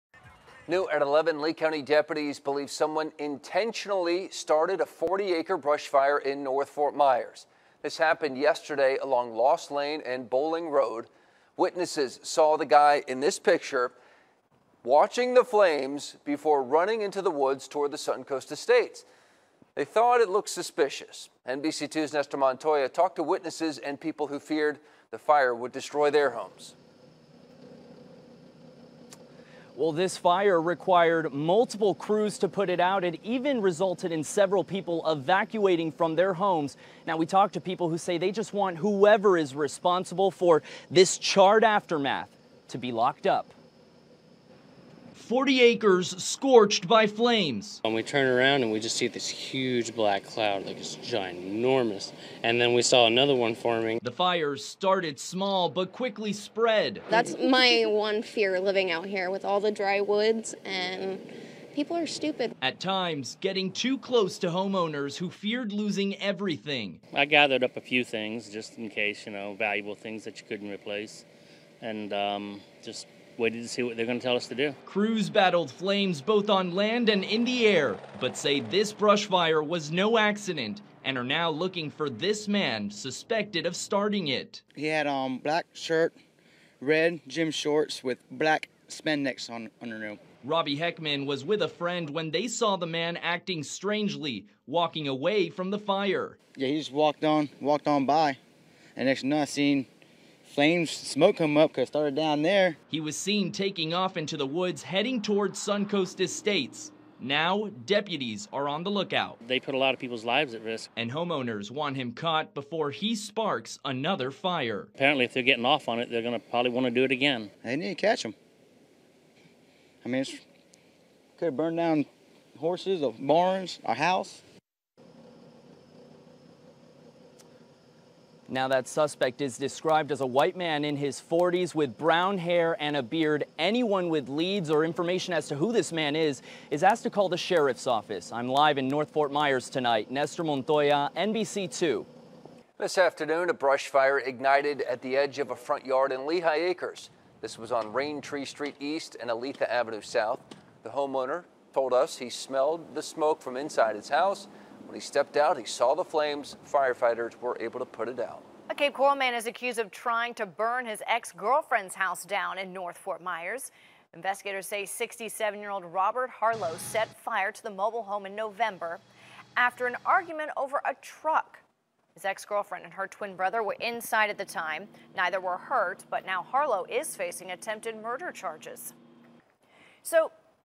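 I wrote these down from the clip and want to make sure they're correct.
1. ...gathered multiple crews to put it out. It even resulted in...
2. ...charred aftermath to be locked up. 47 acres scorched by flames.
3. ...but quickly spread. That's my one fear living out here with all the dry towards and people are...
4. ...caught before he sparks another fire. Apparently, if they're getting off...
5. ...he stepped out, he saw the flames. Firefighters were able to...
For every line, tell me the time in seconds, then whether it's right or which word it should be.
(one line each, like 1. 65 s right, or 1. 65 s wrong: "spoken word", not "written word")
1. 30 s wrong: "required", not "gathered"
2. 41 s wrong: "40", not "47"
3. 55 s wrong: "woods", not "towards"
4. 112 s right
5. 154 s right.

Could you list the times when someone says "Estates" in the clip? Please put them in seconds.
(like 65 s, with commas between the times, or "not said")
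18 s, 106 s.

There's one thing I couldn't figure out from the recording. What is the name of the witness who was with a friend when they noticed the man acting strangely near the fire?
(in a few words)
Robbie Heckman.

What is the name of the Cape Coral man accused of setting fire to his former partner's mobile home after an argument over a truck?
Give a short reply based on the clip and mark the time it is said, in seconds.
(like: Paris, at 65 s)
Robert Harlow, at 165 s.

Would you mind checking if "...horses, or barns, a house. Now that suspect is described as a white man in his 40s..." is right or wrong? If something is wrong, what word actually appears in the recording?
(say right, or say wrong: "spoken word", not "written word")
right.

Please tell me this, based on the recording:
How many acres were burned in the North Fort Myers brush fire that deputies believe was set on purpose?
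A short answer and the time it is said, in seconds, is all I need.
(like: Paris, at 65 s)
40, at 4 s.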